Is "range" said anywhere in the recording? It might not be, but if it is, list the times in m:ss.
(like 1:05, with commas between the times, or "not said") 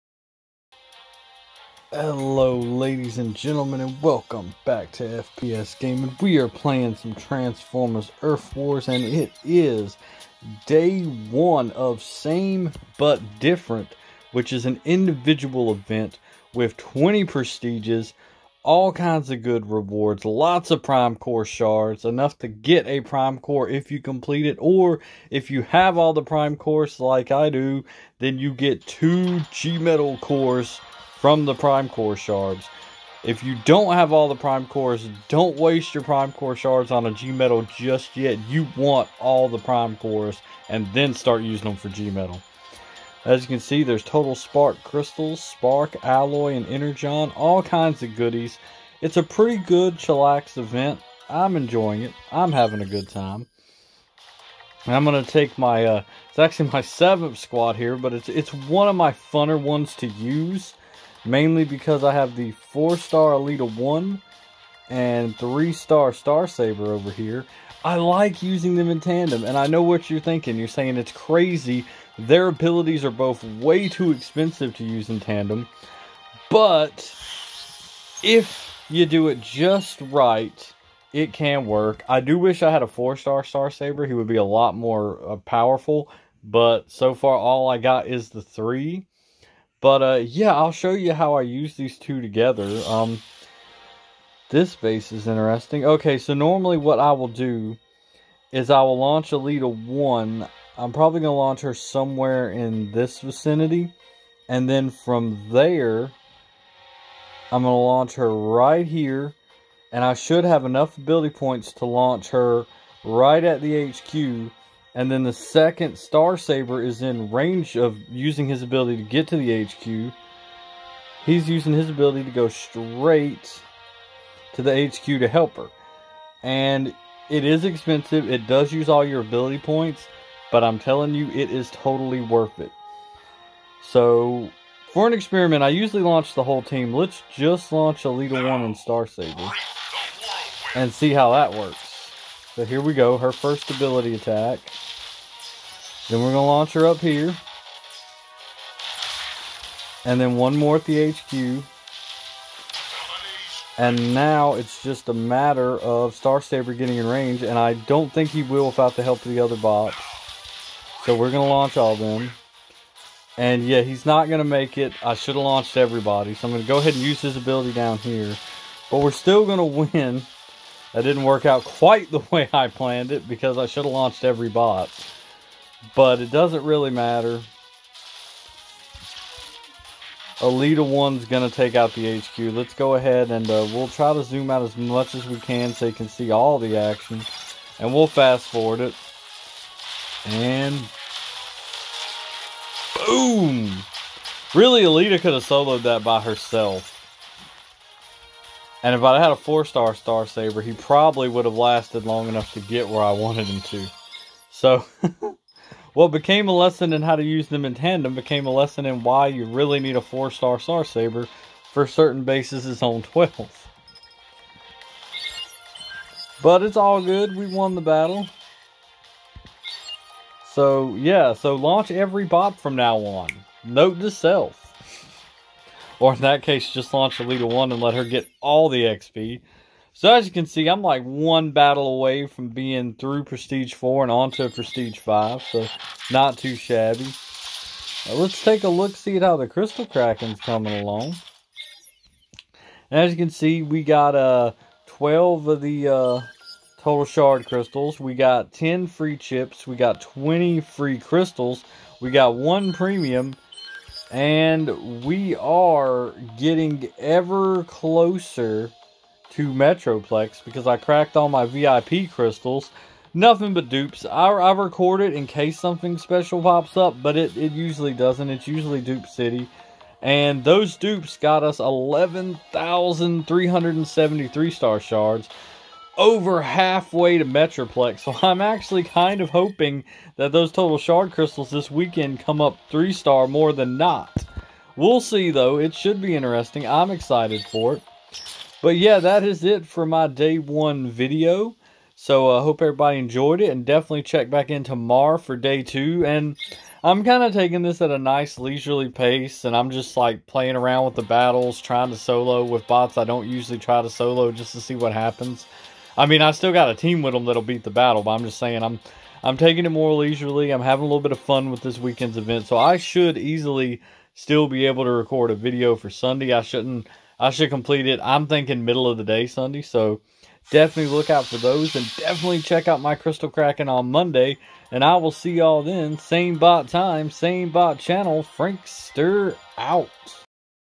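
1:57, 2:37.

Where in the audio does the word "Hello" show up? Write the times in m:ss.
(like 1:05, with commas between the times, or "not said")
0:01.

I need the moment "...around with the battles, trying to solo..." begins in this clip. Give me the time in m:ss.
5:00.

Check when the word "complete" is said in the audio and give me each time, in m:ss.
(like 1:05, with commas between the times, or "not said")
0:24, 5:17.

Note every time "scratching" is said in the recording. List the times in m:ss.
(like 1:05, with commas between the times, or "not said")
not said.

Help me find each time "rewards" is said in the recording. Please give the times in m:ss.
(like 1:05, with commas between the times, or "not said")
0:19.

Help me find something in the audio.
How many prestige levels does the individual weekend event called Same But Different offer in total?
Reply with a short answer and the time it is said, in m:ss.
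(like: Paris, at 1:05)
20, at 0:16.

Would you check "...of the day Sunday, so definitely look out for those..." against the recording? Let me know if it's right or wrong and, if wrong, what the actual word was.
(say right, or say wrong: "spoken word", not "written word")
right.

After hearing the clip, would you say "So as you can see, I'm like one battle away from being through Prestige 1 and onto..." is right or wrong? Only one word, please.
wrong.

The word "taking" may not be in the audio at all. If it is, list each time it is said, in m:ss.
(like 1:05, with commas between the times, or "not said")
4:57, 5:09.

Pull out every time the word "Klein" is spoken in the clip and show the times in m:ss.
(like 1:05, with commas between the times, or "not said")
not said.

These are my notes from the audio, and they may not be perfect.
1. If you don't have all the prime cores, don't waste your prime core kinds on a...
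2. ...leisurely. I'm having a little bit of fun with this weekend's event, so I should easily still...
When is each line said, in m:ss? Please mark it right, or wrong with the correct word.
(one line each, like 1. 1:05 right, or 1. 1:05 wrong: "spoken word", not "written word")
1. 0:33 wrong: "shards", not "kinds"
2. 5:09 right.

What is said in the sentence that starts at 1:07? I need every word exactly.
I like using them in tandem, and I know what you're thinking.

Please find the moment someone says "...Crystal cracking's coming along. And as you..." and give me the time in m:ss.
3:59.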